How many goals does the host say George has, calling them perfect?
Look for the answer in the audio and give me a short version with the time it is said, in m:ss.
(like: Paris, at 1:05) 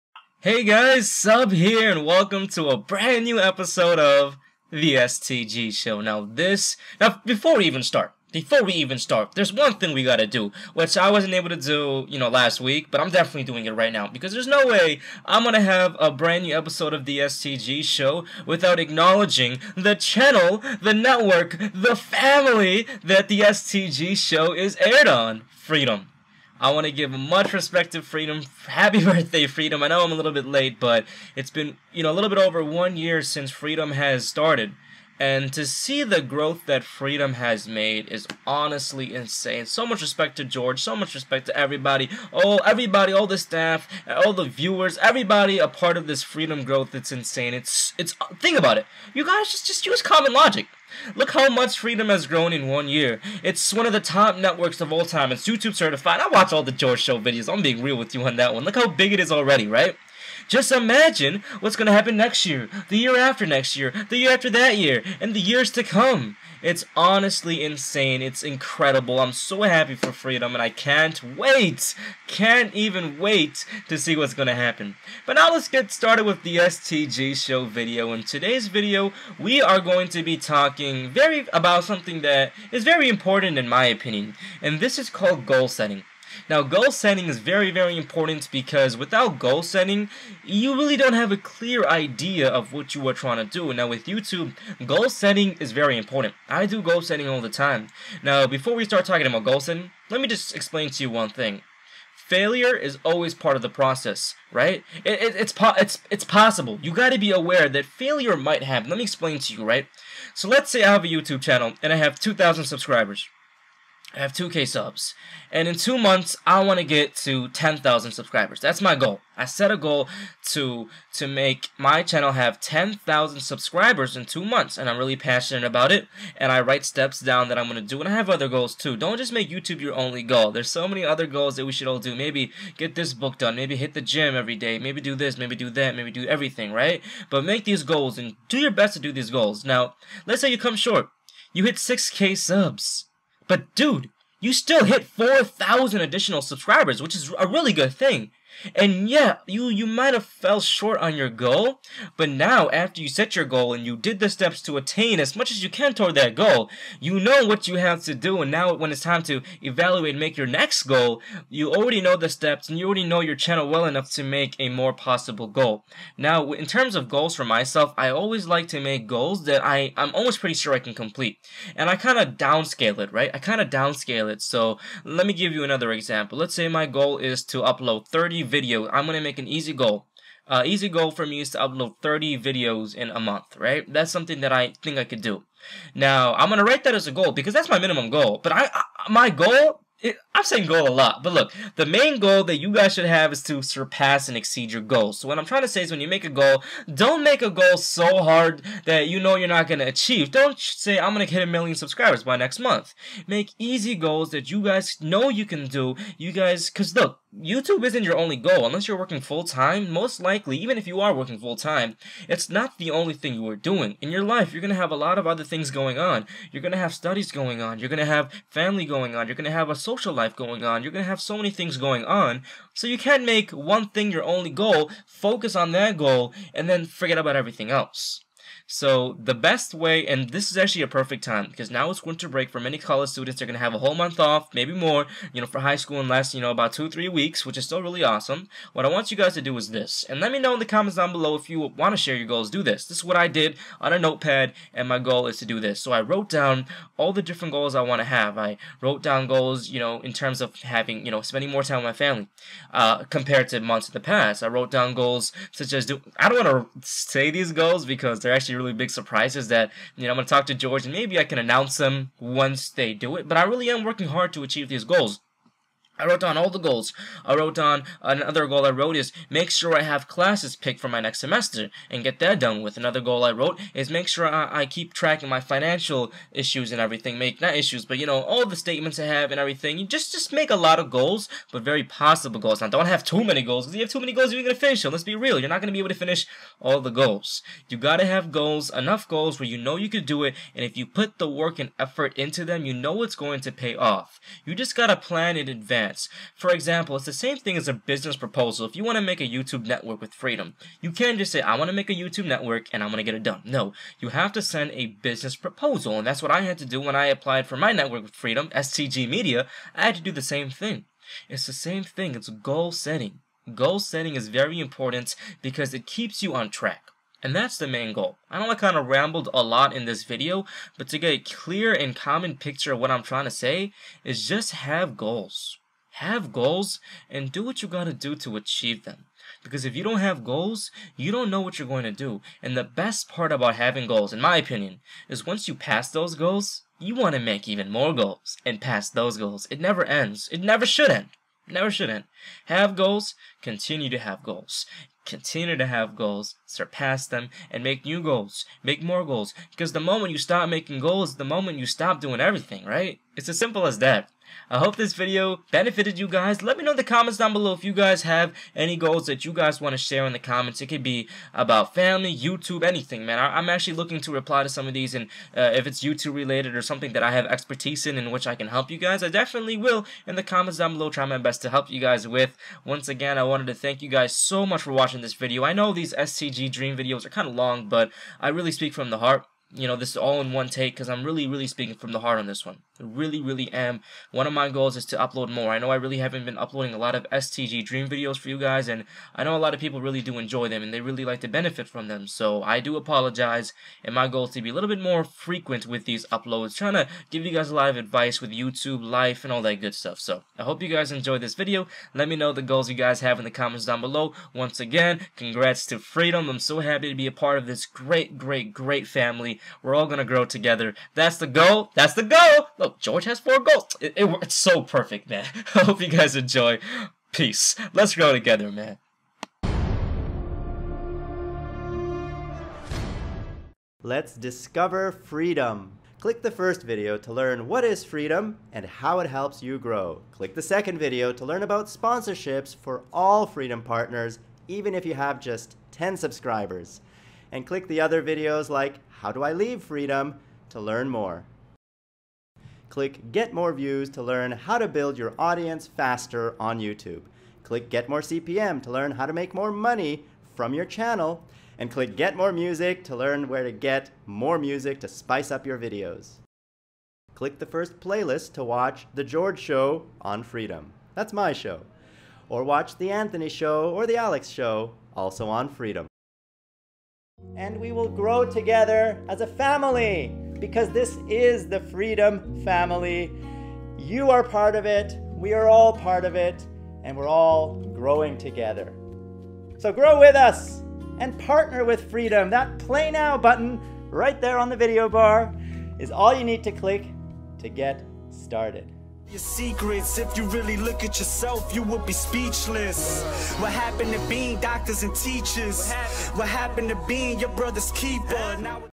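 four, at 6:53.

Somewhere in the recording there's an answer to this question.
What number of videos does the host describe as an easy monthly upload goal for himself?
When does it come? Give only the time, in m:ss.
3:02.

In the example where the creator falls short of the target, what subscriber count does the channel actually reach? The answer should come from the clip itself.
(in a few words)
6k.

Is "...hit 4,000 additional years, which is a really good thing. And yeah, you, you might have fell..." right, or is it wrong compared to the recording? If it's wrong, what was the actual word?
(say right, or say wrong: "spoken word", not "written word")
wrong: "subscribers", not "years".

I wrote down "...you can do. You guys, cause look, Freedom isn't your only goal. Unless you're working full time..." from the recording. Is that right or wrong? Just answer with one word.
wrong.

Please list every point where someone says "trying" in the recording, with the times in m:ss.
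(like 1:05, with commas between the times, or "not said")
1:33, 3:15, 5:23, 6:36.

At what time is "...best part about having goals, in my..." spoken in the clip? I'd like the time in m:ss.
5:32.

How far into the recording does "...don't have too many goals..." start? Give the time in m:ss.
4:42.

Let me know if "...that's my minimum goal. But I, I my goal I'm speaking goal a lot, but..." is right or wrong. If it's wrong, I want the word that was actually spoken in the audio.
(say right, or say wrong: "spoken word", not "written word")
wrong: "saying", not "speaking".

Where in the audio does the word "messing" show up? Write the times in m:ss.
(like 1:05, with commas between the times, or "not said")
not said.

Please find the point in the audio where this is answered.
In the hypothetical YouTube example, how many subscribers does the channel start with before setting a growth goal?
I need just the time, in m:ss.
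1:52.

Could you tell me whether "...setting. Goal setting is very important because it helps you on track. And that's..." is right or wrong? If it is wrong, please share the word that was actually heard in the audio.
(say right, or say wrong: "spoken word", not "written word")
wrong: "keeps", not "helps".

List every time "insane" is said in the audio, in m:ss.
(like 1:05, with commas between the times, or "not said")
0:39, 0:47, 1:07.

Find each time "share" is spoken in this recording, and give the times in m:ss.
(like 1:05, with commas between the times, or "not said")
4:01, 5:59.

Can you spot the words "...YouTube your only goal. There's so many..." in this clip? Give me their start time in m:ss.
2:09.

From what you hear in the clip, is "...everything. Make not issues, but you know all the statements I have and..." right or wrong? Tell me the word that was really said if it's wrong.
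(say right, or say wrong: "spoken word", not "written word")
right.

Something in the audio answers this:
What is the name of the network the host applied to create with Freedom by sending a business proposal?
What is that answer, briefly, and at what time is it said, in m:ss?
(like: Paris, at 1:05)
STG Media, at 5:08.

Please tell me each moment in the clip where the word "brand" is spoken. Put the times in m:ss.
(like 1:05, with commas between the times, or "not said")
0:02, 0:16.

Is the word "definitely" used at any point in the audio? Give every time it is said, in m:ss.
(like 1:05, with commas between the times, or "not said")
0:13, 6:09.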